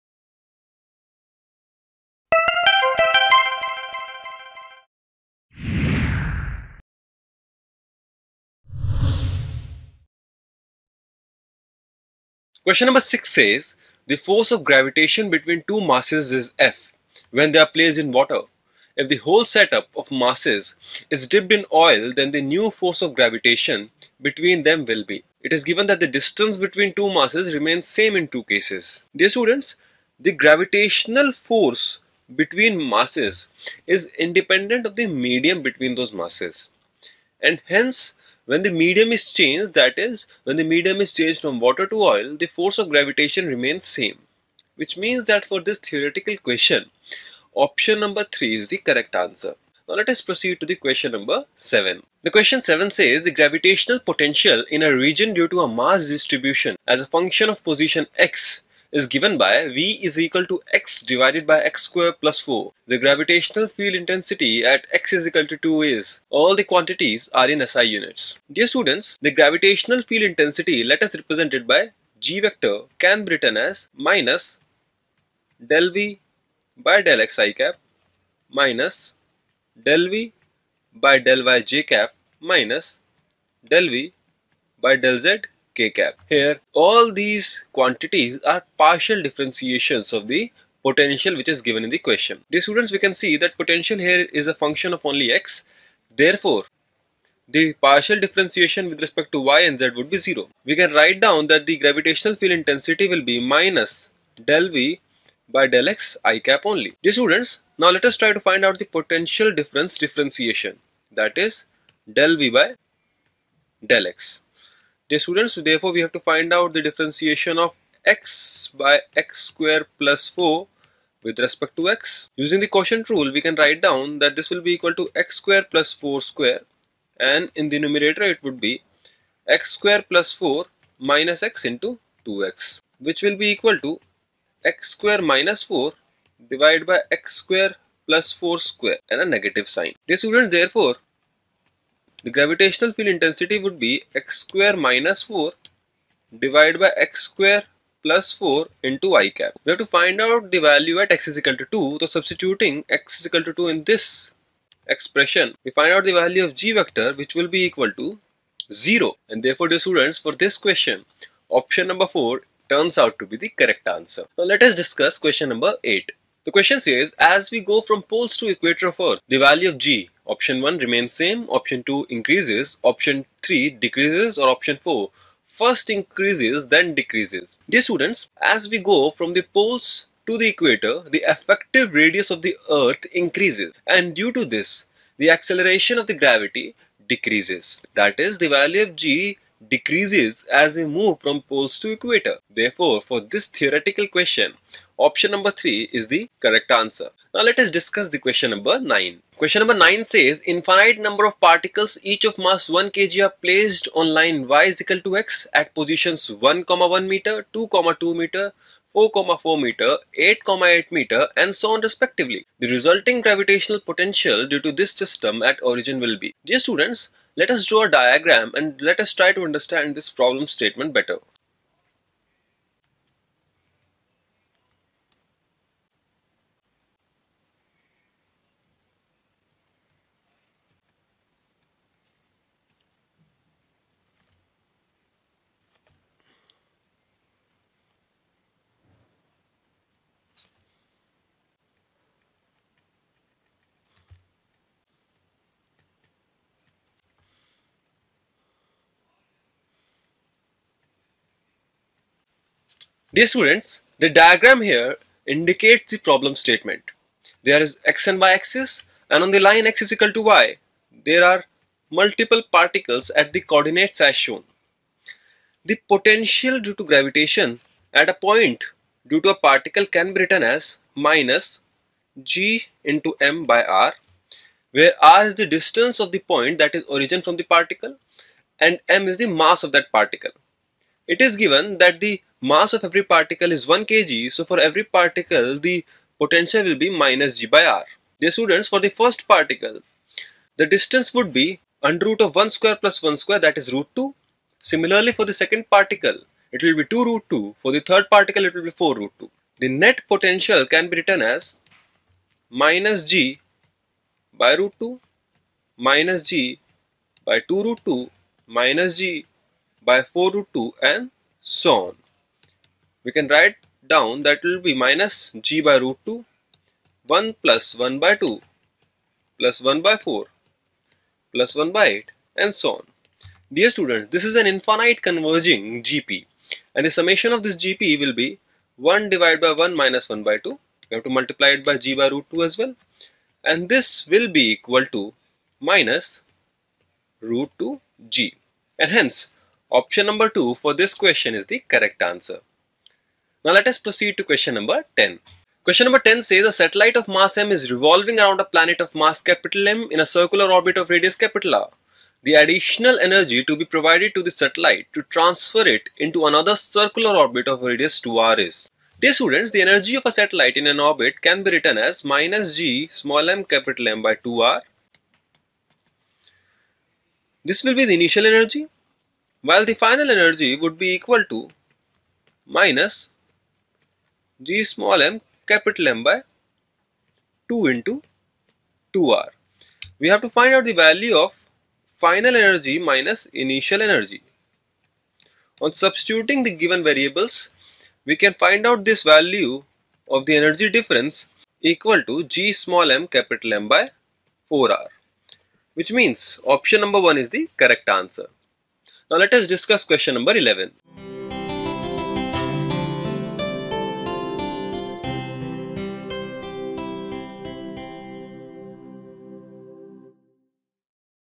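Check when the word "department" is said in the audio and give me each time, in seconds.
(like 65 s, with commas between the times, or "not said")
not said.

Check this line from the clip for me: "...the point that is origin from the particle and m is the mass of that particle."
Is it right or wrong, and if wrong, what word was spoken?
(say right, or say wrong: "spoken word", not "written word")
right.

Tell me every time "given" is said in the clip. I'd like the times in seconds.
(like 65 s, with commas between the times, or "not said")
25 s, 59 s, 91 s, 281 s, 386 s.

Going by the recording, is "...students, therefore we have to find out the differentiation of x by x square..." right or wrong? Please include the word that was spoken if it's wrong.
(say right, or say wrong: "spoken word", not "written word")
right.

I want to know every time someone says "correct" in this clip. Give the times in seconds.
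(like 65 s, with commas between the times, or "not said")
48 s, 163 s, 196 s, 341 s, 397 s.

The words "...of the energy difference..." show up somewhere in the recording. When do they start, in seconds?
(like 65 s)
390 s.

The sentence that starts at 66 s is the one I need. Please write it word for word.
All the quantities are in SI units.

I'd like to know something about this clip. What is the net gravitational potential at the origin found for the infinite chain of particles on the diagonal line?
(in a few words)
minus root 2 G.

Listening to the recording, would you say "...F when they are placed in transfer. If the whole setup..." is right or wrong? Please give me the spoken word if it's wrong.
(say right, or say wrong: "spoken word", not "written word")
wrong: "water", not "transfer".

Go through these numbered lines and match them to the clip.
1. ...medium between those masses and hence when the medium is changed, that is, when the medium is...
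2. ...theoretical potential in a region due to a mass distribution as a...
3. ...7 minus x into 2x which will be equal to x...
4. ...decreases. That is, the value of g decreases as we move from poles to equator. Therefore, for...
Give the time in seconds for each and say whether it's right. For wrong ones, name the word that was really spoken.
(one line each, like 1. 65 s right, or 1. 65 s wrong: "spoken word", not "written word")
1. 35 s right
2. 53 s wrong: "gravitational", not "theoretical"
3. 130 s wrong: "4", not "7"
4. 187 s right.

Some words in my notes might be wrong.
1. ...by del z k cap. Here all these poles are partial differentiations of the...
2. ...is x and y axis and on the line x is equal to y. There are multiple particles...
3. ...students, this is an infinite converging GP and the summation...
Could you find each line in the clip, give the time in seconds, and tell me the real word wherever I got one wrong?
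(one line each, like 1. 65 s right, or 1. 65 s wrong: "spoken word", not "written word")
1. 84 s wrong: "quantities", not "poles"
2. 257 s right
3. 323 s right.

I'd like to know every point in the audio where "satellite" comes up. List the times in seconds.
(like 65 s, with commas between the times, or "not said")
346 s, 354 s, 360 s.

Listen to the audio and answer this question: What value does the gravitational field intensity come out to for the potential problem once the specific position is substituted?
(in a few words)
0.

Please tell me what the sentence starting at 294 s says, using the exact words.
Similarly for the second particle, it will be 2 root 2.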